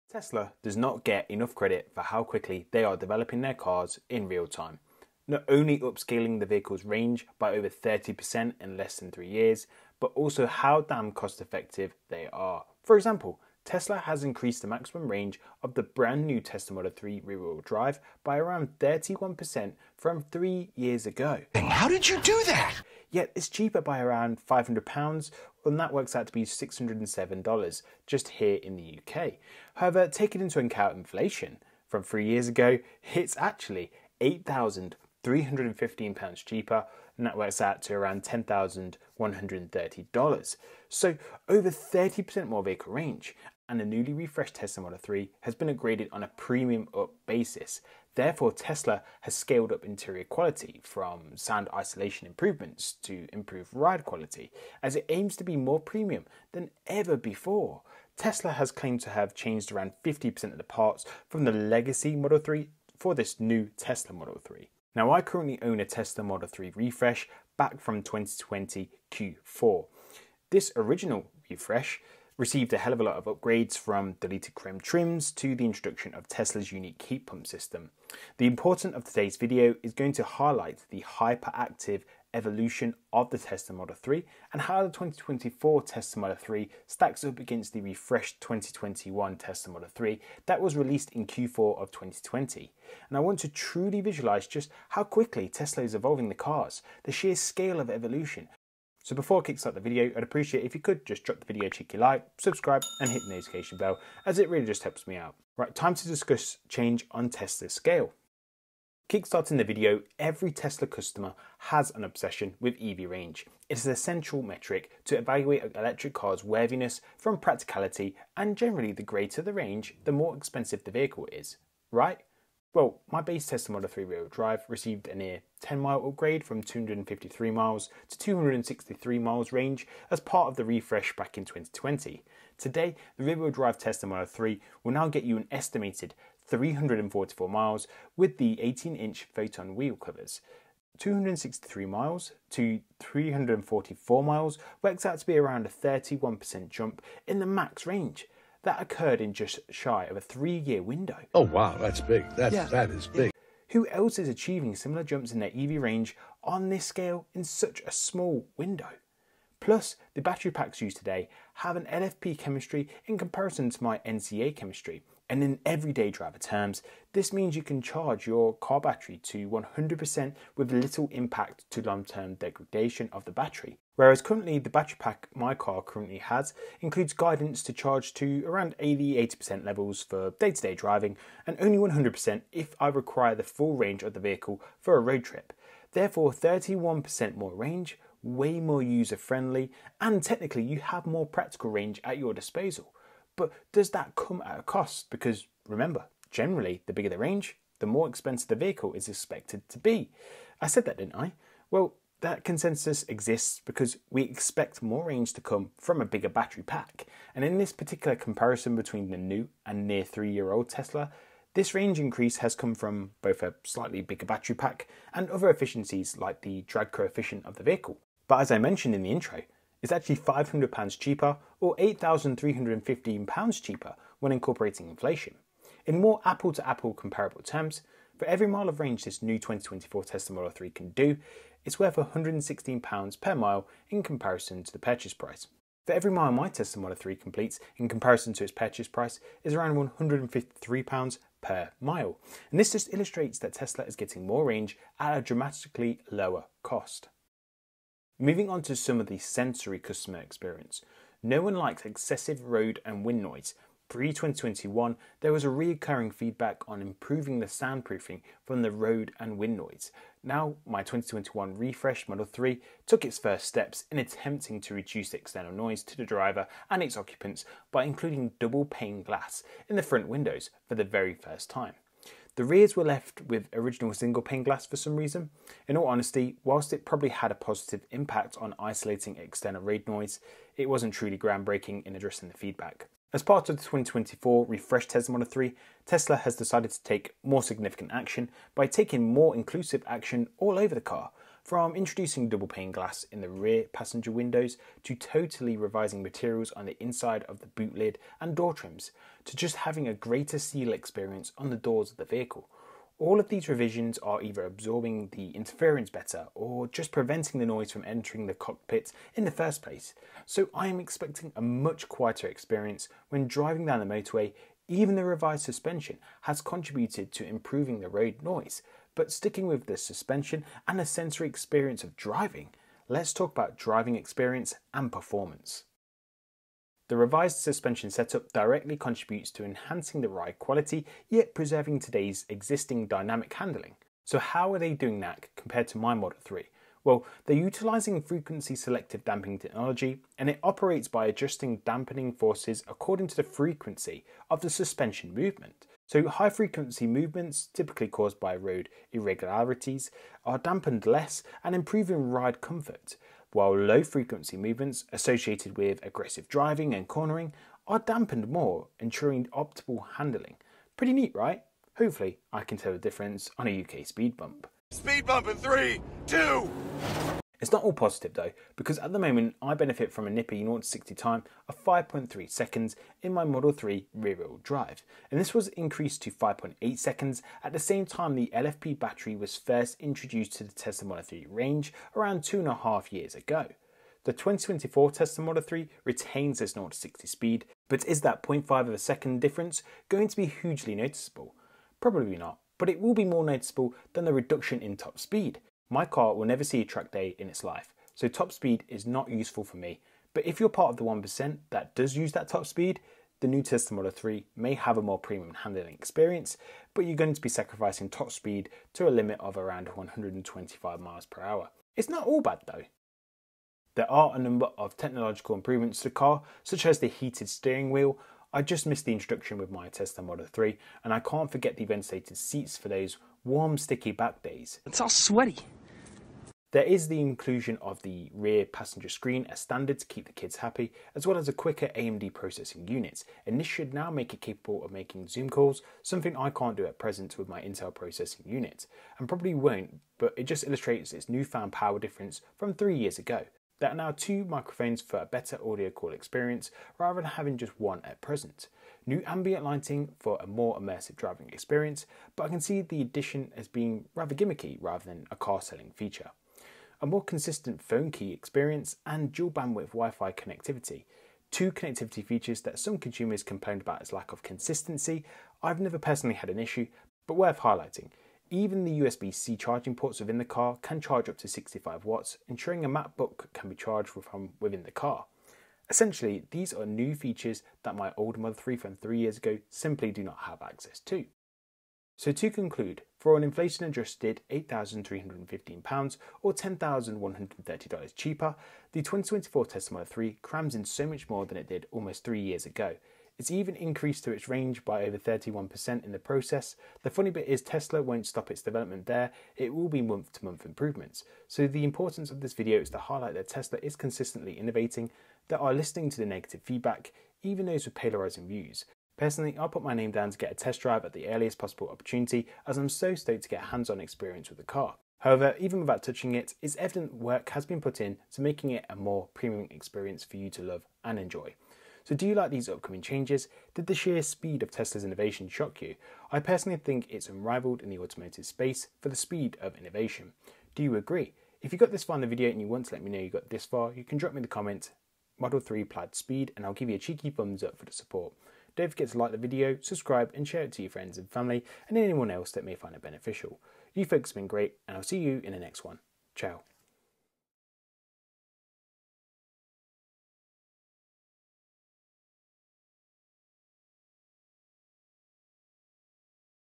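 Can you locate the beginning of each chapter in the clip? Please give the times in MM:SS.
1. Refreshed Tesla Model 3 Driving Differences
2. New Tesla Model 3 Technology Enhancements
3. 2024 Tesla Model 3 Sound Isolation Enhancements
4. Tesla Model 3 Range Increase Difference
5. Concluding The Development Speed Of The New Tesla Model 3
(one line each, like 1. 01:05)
1. 05:26
2. 06:53
3. 04:07
4. 01:48
5. 08:01.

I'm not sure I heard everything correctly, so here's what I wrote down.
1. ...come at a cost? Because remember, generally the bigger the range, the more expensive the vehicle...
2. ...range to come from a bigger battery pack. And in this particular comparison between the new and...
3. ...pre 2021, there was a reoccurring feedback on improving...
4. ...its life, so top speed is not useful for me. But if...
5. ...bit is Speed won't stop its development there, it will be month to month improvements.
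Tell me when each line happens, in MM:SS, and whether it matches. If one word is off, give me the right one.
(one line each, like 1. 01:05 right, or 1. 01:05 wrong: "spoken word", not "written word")
1. 03:14 right
2. 03:25 right
3. 04:13 right
4. 06:37 right
5. 08:17 wrong: "Tesla", not "Speed".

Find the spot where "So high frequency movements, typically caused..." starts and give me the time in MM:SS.
05:45.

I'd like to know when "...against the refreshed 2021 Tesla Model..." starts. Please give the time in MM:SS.
01:27.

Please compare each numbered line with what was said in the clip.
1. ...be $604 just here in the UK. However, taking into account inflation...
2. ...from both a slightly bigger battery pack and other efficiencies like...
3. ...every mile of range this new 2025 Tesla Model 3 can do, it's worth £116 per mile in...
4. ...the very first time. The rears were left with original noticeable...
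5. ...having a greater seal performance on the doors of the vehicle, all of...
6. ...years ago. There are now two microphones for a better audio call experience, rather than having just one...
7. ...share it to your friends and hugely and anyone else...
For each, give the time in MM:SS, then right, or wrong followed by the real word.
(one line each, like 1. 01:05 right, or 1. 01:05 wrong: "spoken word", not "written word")
1. 00:26 wrong: "607", not "604"
2. 03:32 right
3. 03:48 wrong: "2024", not "2025"
4. 04:30 wrong: "single", not "noticeable"
5. 04:59 wrong: "experience", not "performance"
6. 07:22 right
7. 09:00 wrong: "family", not "hugely".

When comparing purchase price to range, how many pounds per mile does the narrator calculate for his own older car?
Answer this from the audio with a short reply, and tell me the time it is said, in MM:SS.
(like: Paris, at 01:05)
£153, at 03:59.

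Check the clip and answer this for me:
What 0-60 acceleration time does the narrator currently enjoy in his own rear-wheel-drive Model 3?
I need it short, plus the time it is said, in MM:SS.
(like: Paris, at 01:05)
5.3 seconds, at 06:11.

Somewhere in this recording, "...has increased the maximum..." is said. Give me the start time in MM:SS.
00:13.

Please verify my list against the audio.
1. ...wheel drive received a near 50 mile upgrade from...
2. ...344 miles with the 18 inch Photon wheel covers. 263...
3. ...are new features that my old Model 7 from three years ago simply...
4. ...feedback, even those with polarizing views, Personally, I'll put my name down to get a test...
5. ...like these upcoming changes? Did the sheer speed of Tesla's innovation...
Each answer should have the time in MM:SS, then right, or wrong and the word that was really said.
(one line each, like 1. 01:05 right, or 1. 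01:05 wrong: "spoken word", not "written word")
1. 02:04 wrong: "10", not "50"
2. 02:16 right
3. 07:56 wrong: "3", not "7"
4. 08:26 right
5. 08:42 right.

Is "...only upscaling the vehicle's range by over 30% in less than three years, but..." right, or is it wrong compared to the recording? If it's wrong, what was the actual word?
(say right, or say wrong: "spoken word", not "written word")
right.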